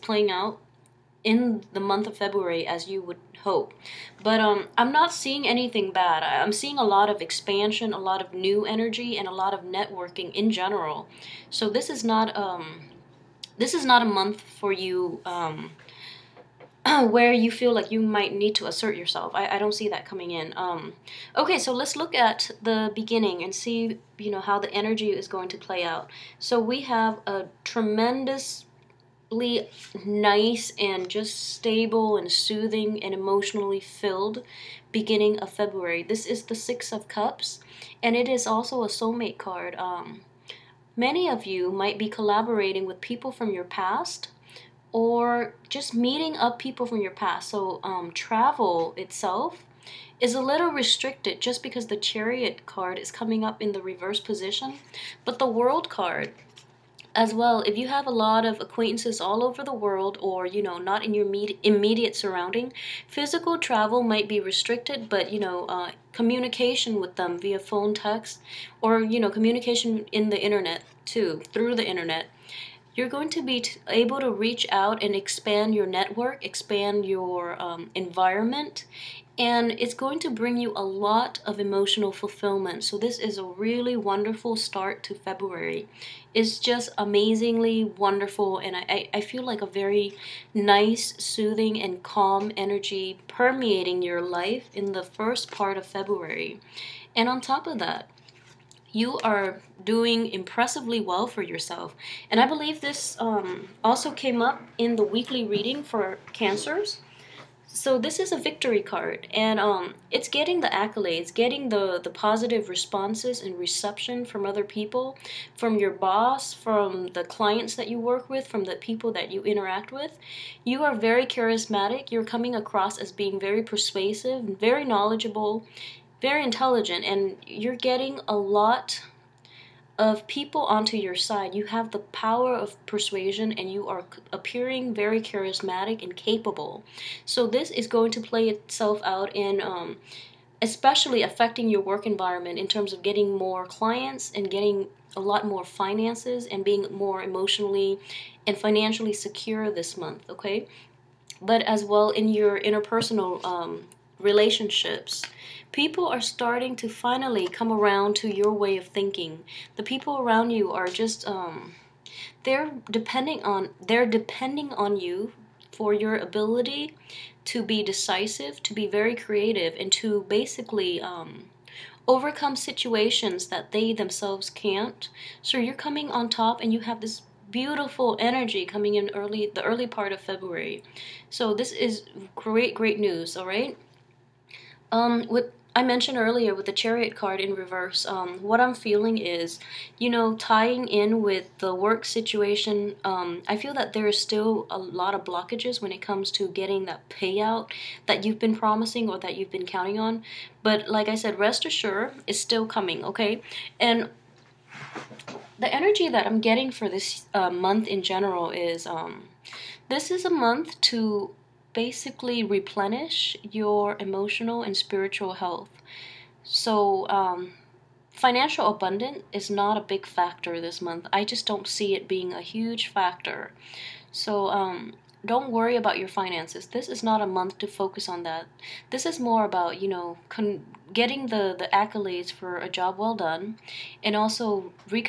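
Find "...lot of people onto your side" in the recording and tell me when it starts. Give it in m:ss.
2:08.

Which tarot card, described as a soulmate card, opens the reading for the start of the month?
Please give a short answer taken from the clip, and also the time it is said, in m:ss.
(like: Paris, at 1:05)
Six of Cups, at 0:36.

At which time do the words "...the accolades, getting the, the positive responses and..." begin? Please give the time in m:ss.
1:50.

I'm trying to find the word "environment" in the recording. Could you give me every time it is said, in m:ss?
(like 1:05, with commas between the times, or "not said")
1:17, 2:22.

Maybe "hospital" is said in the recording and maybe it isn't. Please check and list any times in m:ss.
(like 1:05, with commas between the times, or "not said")
not said.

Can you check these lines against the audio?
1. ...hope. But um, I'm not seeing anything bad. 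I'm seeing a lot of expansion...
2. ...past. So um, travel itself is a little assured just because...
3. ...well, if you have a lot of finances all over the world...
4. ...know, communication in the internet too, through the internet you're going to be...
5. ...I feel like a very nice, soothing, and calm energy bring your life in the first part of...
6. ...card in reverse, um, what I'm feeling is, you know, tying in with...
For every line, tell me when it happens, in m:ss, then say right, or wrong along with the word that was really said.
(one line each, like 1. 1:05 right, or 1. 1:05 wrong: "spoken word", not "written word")
1. 0:03 right
2. 0:47 wrong: "restricted", not "assured"
3. 0:57 wrong: "acquaintances", not "finances"
4. 1:09 right
5. 1:29 wrong: "permeating", not "bring"
6. 3:07 right.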